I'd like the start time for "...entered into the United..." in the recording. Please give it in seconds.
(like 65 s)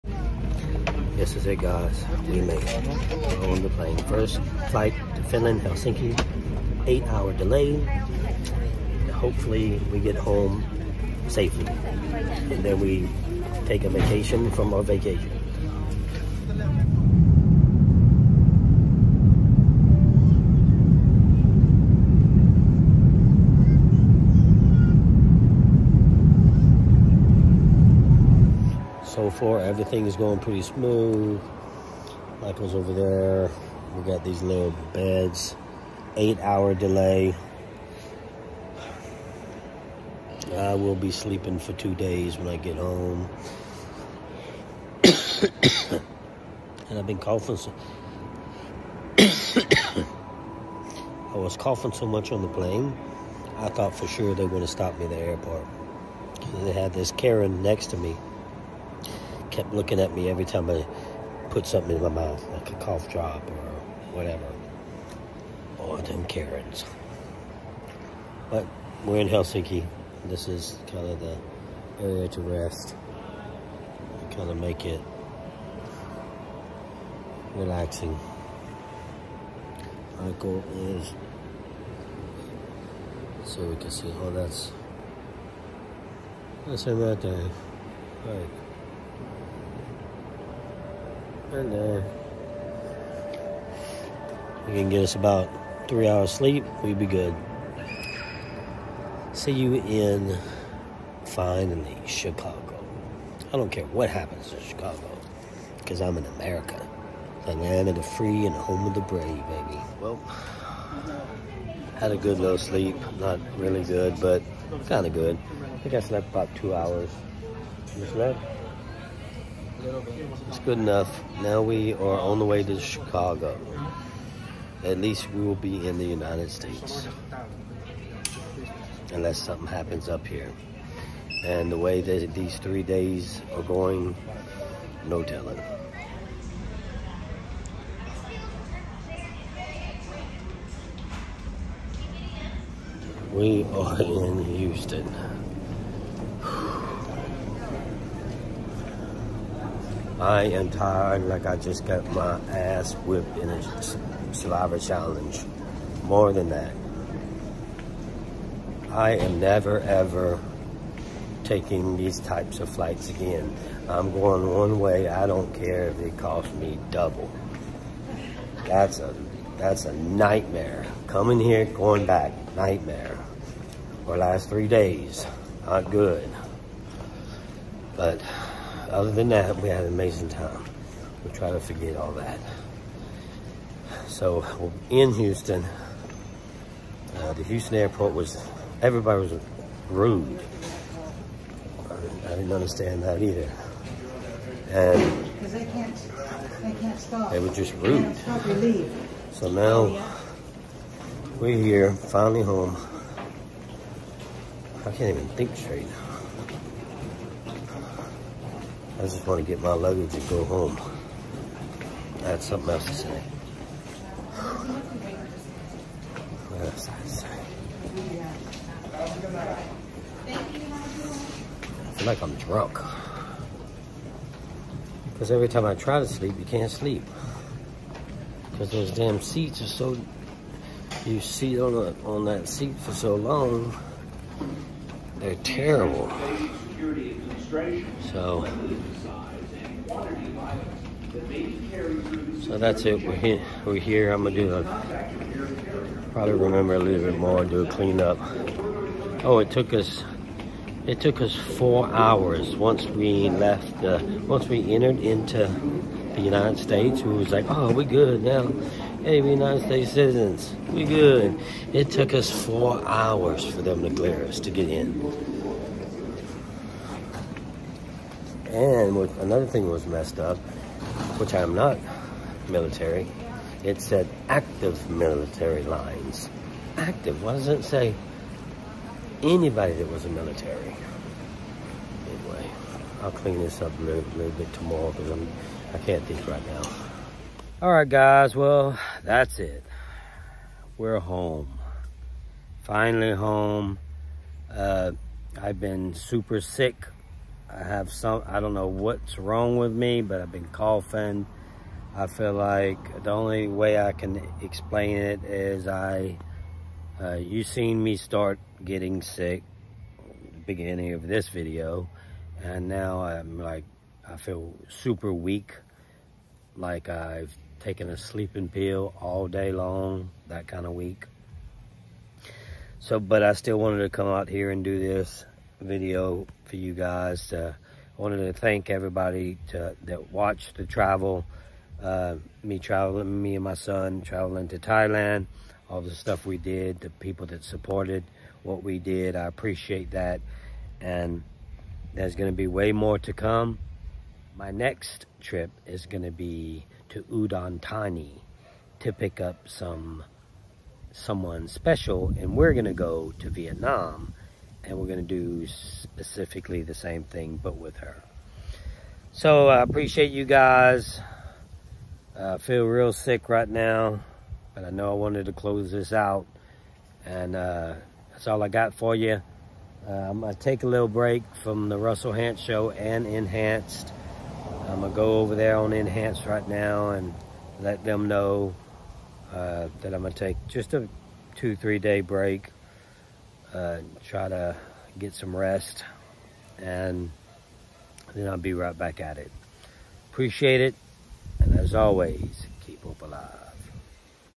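254 s.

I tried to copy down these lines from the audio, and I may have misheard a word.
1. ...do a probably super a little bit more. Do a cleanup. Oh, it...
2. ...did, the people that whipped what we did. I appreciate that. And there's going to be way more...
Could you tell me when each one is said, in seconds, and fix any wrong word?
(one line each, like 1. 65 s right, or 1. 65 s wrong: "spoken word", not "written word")
1. 244 s wrong: "remember", not "super"
2. 336 s wrong: "supported", not "whipped".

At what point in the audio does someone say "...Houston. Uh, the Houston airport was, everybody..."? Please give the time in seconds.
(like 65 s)
185 s.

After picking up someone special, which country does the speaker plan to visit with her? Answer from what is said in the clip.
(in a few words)
Vietnam.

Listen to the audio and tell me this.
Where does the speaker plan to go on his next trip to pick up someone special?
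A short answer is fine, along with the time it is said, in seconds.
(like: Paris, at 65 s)
Udon Thani, at 347 s.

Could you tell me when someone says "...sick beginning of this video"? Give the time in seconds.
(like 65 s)
309 s.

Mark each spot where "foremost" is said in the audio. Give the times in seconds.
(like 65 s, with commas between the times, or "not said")
not said.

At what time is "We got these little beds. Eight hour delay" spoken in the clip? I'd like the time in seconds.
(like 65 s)
33 s.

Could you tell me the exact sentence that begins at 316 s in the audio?
Like I've taking a sleeping pill all day long, that kind of week.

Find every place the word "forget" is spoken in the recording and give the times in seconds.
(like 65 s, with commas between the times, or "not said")
181 s.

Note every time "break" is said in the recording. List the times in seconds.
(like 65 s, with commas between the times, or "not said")
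370 s, 381 s.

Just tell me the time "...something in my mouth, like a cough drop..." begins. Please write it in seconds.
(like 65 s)
61 s.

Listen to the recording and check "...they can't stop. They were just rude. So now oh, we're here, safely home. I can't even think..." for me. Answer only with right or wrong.
wrong.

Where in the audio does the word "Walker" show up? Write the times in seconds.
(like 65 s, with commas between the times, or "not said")
not said.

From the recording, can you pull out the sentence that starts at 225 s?
Because every time I try to sleep, you can't sleep.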